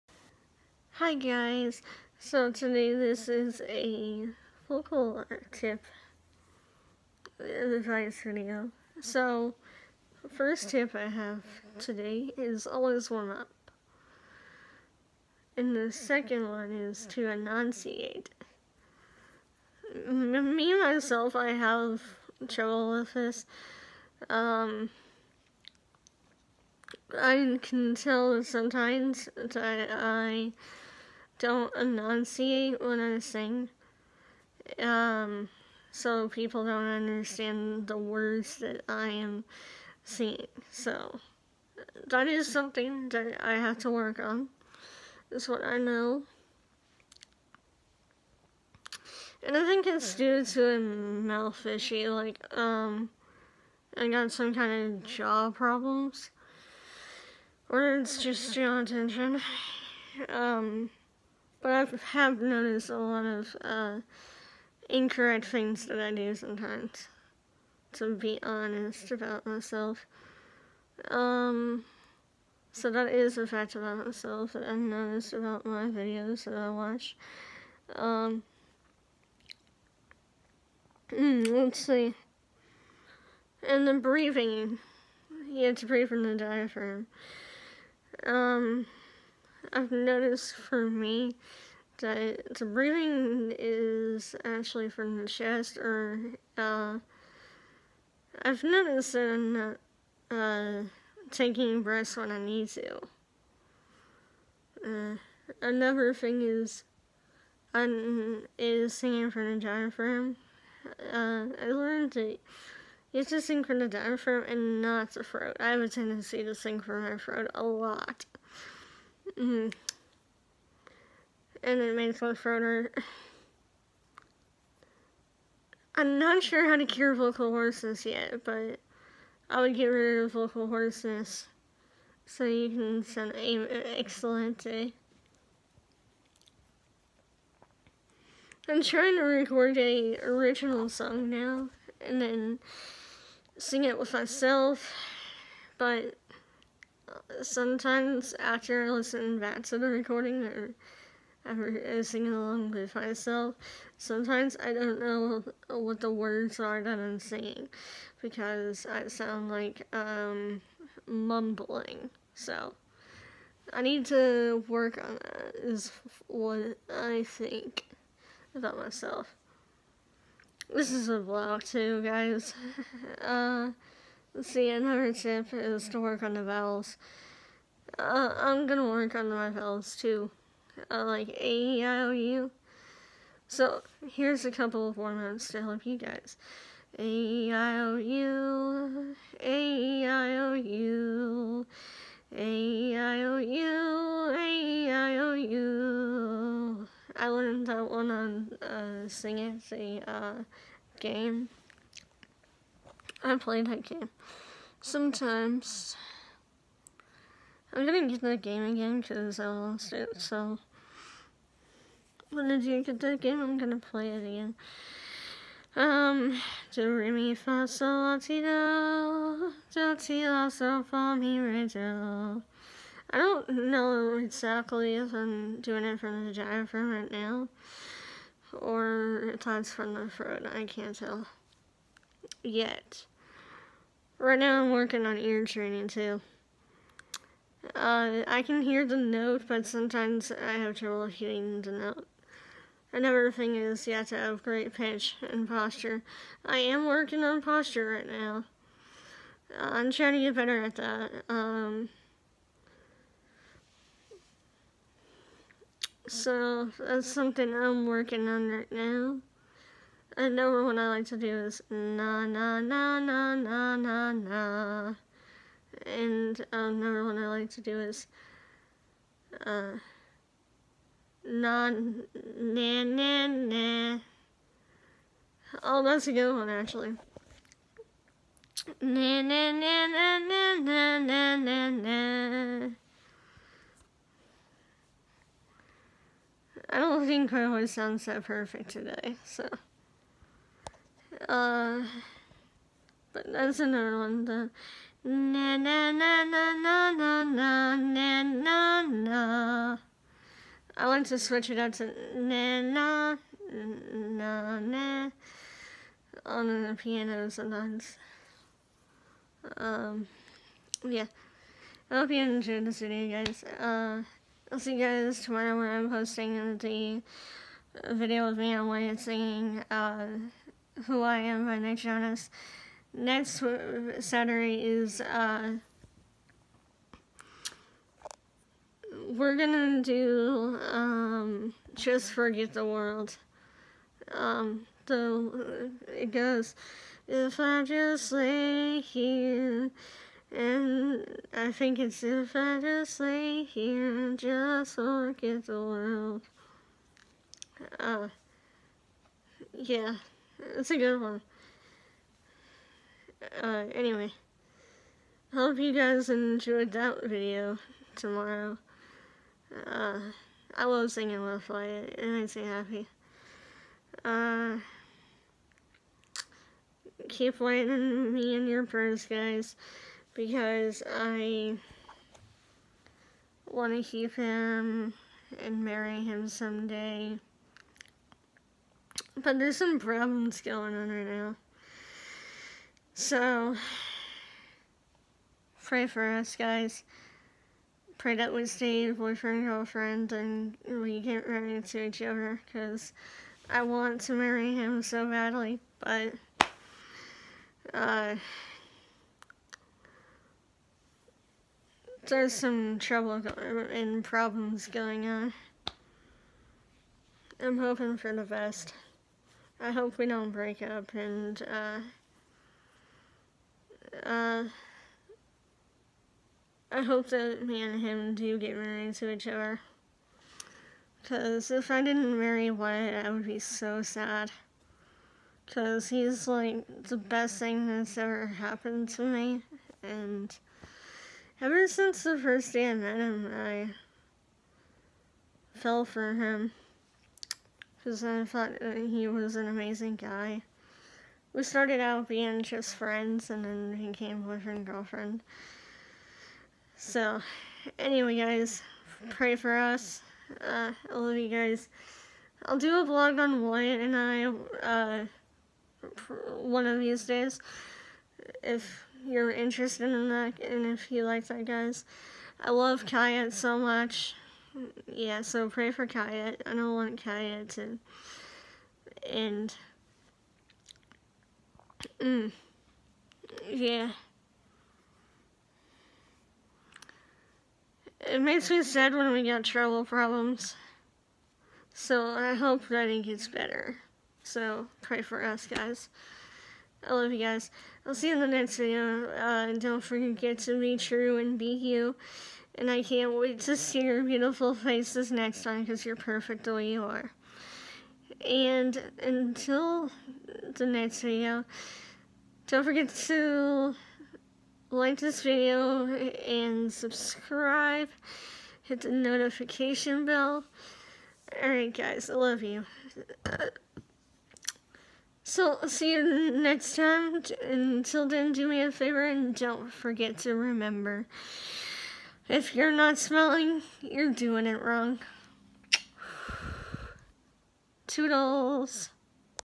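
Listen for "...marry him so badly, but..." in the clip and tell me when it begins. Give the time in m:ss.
6:34.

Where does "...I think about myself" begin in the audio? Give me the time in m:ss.
2:46.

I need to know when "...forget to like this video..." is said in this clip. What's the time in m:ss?
8:22.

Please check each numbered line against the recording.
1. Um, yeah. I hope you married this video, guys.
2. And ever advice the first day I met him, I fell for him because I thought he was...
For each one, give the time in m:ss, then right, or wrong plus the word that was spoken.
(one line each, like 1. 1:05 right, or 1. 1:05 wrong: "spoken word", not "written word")
1. 5:09 wrong: "enjoyed", not "married"
2. 7:09 wrong: "since", not "advice".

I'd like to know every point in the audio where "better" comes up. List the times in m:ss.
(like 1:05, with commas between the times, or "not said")
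4:10, 8:03.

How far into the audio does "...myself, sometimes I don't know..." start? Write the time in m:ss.
2:32.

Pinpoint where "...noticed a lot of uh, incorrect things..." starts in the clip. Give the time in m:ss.
1:02.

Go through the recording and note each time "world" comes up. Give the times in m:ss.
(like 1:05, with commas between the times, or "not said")
5:32, 5:45.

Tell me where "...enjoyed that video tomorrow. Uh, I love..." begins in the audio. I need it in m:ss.
5:56.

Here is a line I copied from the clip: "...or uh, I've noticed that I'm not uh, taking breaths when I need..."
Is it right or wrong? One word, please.
right.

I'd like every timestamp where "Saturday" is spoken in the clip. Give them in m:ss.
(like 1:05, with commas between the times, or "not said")
5:23.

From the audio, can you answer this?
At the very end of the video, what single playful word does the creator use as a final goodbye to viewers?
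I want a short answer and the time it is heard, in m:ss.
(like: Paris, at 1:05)
Toodles, at 8:47.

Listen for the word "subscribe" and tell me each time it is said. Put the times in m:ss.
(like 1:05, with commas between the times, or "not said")
8:26.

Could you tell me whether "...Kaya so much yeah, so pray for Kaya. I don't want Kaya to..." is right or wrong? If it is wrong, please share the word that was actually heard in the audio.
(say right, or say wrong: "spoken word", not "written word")
right.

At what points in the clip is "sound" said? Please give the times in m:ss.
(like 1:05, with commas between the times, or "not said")
2:39, 4:47.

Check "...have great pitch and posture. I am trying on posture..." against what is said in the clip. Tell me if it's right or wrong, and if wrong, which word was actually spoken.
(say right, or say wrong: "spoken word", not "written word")
wrong: "working", not "trying".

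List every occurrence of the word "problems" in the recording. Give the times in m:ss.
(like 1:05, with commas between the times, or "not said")
0:55, 6:19, 6:44, 7:59.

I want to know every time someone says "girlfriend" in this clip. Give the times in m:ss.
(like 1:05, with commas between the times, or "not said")
6:29, 7:24.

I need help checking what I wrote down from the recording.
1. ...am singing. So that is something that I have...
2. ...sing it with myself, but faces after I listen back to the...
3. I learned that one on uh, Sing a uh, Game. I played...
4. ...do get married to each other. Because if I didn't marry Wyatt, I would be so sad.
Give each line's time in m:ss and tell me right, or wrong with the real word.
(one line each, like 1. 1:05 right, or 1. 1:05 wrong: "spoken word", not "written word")
1. 0:39 right
2. 2:23 wrong: "sometimes", not "faces"
3. 3:17 right
4. 6:58 right.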